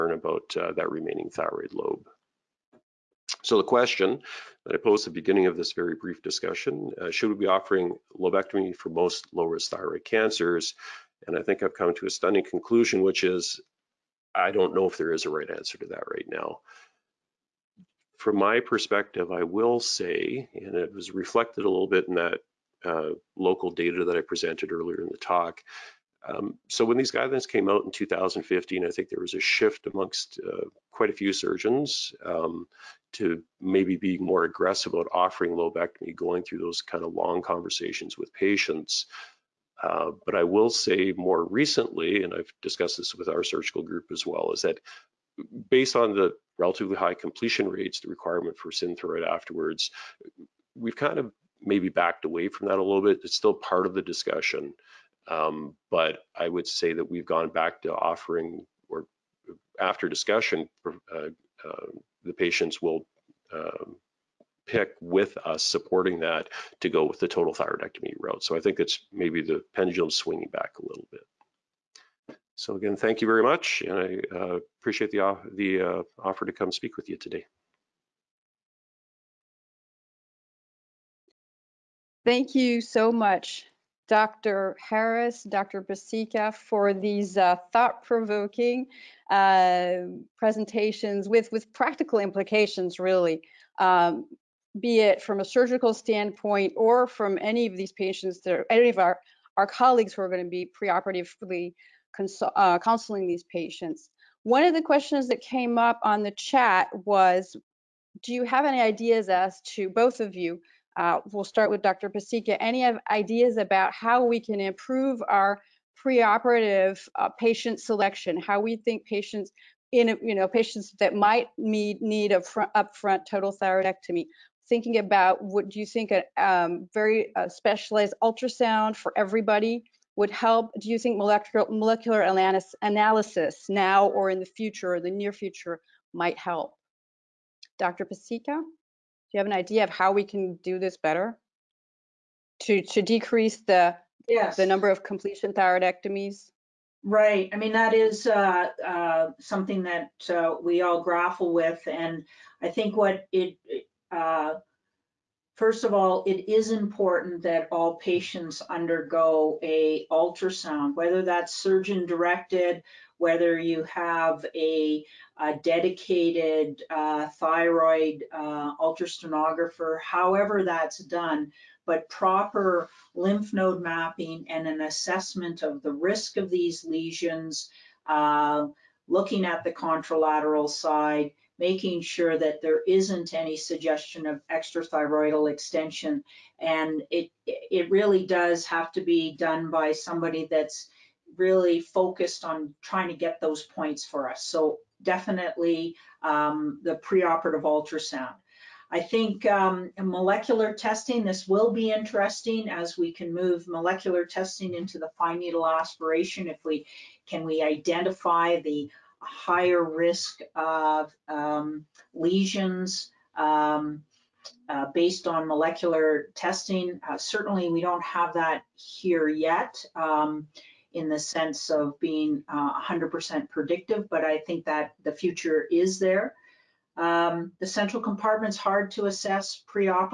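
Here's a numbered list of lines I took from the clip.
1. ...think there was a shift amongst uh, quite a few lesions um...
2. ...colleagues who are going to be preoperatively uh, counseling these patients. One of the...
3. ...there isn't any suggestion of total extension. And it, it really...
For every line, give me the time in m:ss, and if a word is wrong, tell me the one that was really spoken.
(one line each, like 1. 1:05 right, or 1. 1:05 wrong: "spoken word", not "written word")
1. 0:28 wrong: "surgeons", not "lesions"
2. 1:39 right
3. 3:02 wrong: "extrathyroidal", not "total".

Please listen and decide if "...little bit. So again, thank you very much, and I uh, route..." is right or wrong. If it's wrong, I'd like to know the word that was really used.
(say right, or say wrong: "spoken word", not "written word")
wrong: "appreciate", not "route".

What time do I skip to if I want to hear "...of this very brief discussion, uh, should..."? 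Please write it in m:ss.
0:05.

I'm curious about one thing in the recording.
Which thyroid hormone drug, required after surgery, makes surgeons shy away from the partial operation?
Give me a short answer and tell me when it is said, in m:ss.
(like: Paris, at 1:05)
Synthroid, at 0:48.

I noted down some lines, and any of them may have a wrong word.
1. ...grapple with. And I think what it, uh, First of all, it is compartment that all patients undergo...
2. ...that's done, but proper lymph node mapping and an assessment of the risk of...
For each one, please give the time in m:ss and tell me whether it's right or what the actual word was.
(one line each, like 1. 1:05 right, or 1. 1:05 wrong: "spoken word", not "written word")
1. 2:31 wrong: "important", not "compartment"
2. 2:50 right.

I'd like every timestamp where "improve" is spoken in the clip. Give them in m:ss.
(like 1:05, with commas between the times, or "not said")
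1:54.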